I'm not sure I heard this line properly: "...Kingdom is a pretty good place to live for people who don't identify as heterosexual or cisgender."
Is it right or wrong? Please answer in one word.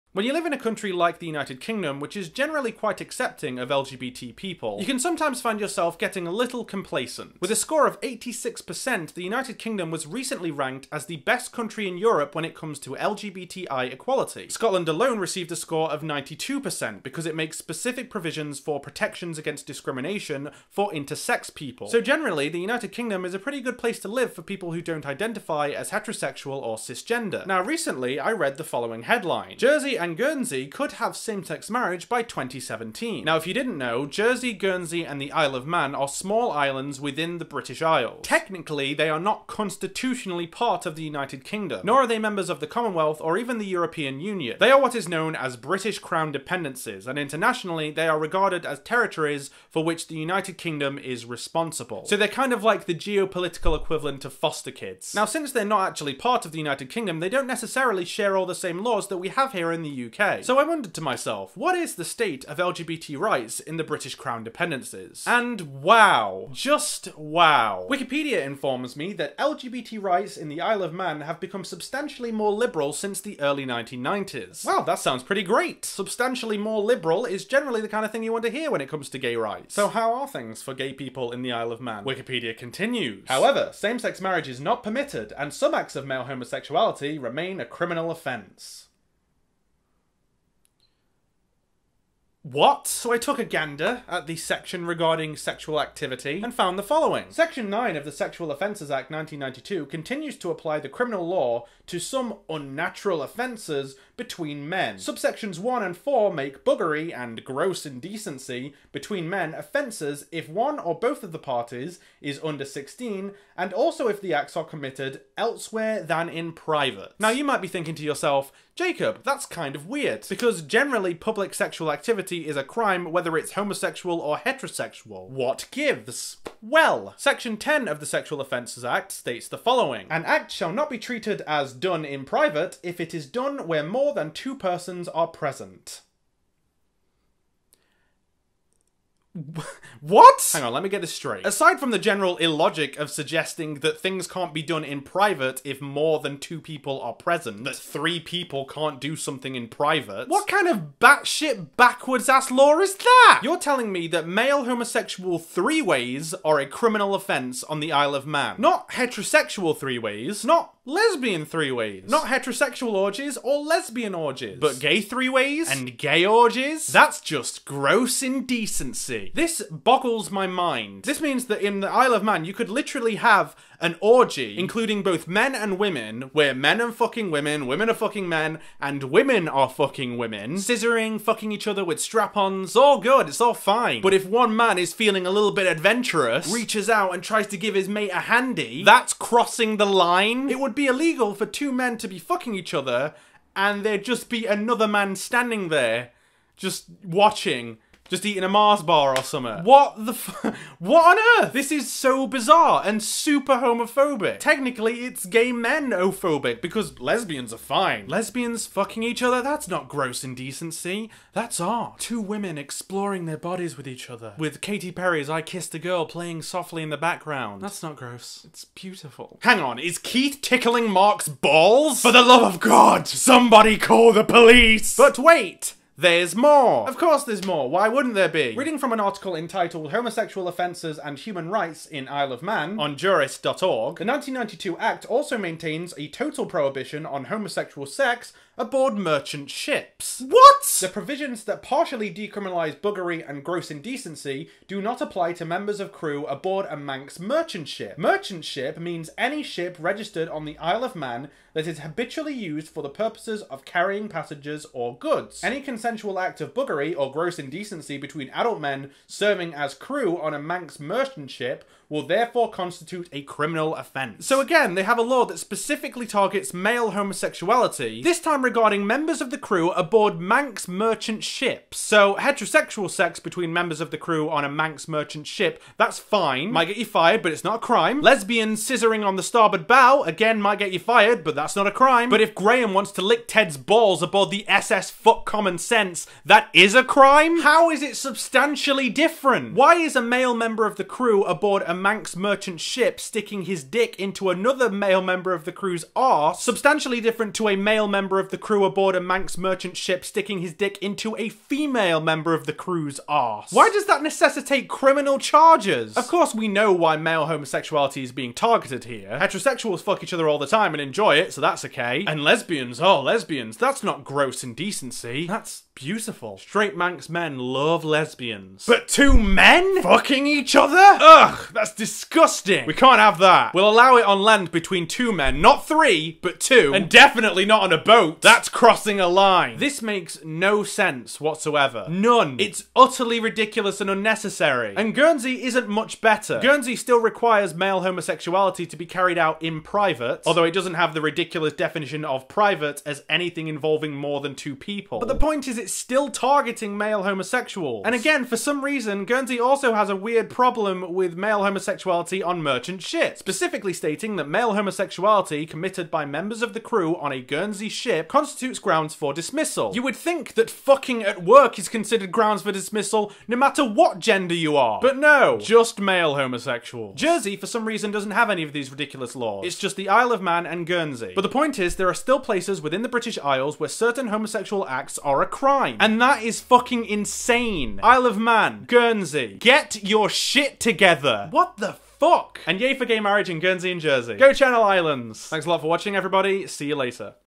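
right.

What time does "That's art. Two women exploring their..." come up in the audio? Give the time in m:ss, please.
3:31.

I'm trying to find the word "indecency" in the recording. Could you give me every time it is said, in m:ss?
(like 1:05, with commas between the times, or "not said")
1:47, 2:48, 3:30, 4:03, 4:17, 5:14.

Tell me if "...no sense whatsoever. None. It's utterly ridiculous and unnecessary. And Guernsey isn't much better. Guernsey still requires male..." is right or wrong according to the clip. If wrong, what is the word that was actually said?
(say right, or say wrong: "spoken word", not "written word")
right.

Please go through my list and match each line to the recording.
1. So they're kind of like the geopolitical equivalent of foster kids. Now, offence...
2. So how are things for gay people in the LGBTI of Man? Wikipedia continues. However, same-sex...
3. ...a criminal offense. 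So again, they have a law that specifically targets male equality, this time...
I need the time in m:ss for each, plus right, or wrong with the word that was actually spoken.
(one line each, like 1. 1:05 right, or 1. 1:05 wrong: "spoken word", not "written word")
1. 0:52 wrong: "since", not "offence"
2. 1:19 wrong: "Isle", not "LGBTI"
3. 4:23 wrong: "homosexuality", not "equality".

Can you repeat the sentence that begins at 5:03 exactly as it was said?
Why does that necessitate criminal charges?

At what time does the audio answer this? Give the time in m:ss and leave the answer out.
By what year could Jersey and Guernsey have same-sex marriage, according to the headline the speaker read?
0:32.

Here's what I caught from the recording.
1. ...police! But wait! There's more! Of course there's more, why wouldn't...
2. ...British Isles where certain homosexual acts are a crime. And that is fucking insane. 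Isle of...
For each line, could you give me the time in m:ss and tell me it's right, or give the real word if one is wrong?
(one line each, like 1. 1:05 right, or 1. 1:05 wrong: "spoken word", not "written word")
1. 3:44 right
2. 6:12 right.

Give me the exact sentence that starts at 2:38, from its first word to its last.
Not heterosexual three ways, not lesbian three ways.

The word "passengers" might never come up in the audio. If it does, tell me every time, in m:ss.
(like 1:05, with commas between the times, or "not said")
4:14.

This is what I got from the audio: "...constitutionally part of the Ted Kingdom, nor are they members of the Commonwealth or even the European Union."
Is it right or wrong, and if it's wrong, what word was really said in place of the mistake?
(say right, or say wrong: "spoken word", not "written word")
wrong: "United", not "Ted".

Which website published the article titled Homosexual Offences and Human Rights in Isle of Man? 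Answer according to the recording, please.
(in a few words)
jurist.org.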